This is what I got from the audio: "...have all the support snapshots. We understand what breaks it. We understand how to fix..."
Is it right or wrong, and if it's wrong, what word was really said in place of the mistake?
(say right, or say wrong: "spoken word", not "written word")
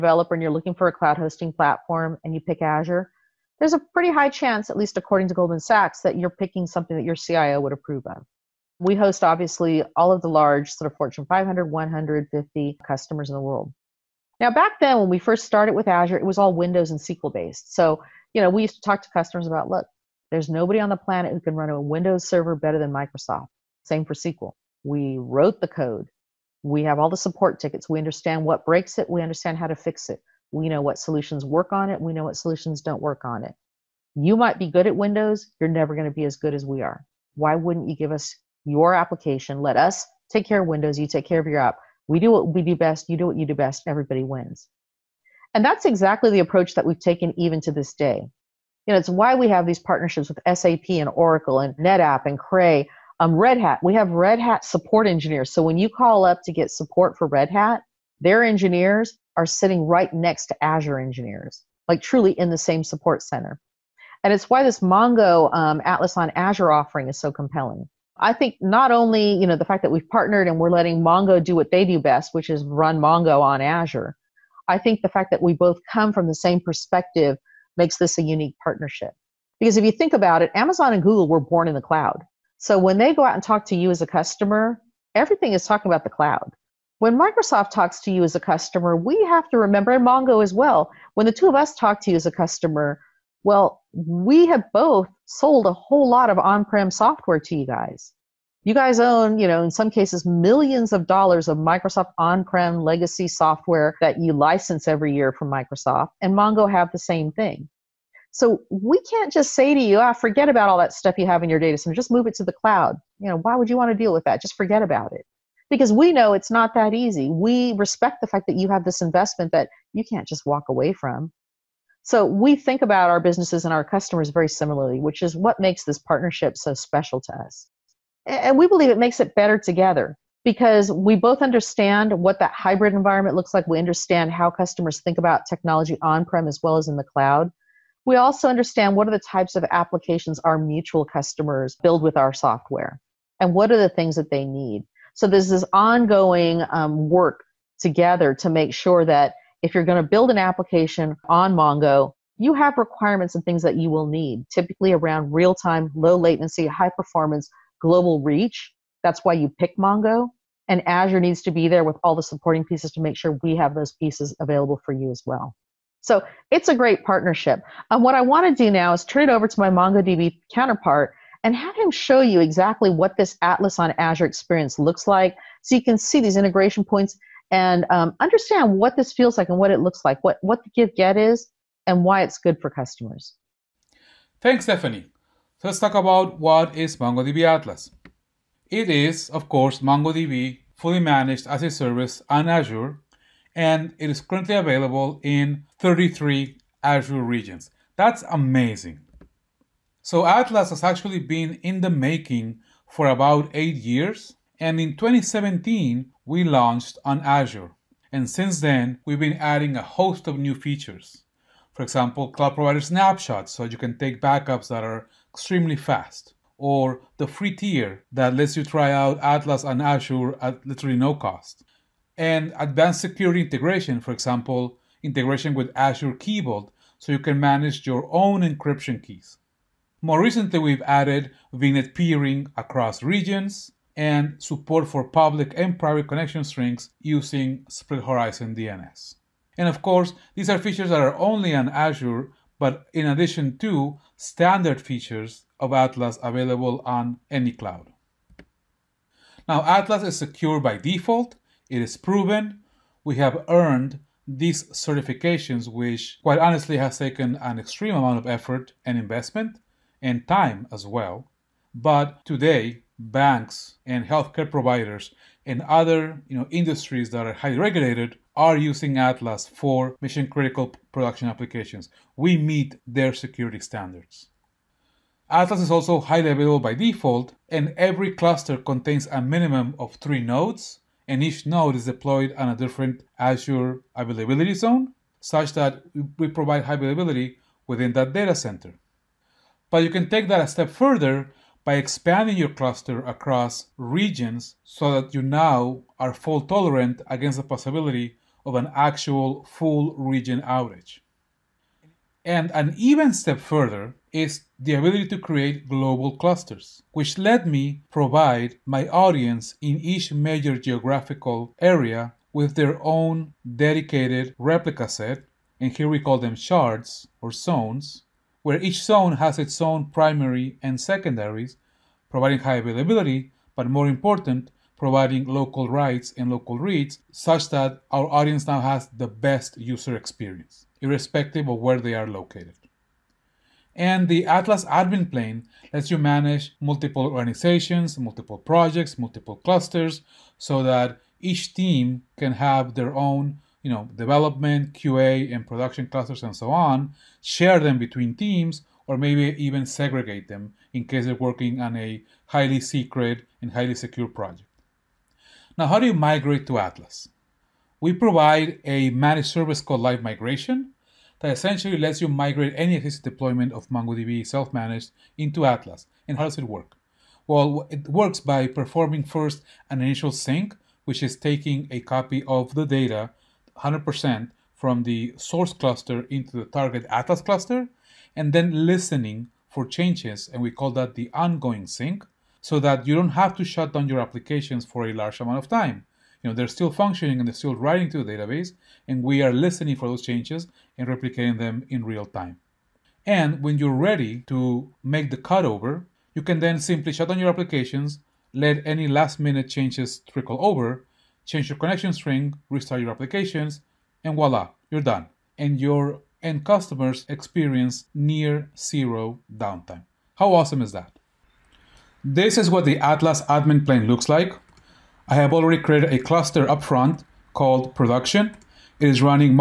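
wrong: "tickets", not "snapshots".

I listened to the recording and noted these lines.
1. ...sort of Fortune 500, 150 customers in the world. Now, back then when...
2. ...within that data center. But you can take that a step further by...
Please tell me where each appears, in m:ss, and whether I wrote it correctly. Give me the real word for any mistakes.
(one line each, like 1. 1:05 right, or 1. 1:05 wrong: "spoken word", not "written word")
1. 0:10 right
2. 4:47 right.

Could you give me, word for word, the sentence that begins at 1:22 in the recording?
So when they go out and talk to you as a customer, everything is talking about the cloud.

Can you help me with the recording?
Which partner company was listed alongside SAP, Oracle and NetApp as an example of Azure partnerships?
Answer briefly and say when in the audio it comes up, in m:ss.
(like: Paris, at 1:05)
Cray, at 0:52.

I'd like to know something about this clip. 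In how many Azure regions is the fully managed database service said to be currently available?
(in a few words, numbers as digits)
33.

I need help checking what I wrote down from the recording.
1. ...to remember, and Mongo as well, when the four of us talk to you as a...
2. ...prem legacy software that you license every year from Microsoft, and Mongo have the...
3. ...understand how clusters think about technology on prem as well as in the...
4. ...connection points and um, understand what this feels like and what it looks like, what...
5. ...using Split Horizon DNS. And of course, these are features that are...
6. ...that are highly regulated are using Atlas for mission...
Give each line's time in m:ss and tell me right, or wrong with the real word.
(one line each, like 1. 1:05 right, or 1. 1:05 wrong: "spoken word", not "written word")
1. 1:29 wrong: "two", not "four"
2. 1:42 right
3. 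2:13 wrong: "customers", not "clusters"
4. 2:56 wrong: "integration", not "connection"
5. 3:57 right
6. 4:27 right.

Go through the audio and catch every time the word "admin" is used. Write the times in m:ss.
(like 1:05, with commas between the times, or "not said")
5:34, 6:53.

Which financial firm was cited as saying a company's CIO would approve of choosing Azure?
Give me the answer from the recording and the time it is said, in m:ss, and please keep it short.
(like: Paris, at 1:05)
Goldman Sachs, at 0:05.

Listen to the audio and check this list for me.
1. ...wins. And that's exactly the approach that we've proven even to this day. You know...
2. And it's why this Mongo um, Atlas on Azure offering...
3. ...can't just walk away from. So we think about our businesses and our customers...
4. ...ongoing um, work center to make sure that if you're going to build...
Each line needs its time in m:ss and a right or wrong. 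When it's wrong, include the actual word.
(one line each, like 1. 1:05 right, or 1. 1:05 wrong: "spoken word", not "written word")
1. 0:44 wrong: "taken", not "proven"
2. 1:04 right
3. 2:00 right
4. 2:25 wrong: "together", not "center".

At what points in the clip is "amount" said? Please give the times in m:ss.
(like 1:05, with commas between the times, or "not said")
4:17, 6:25.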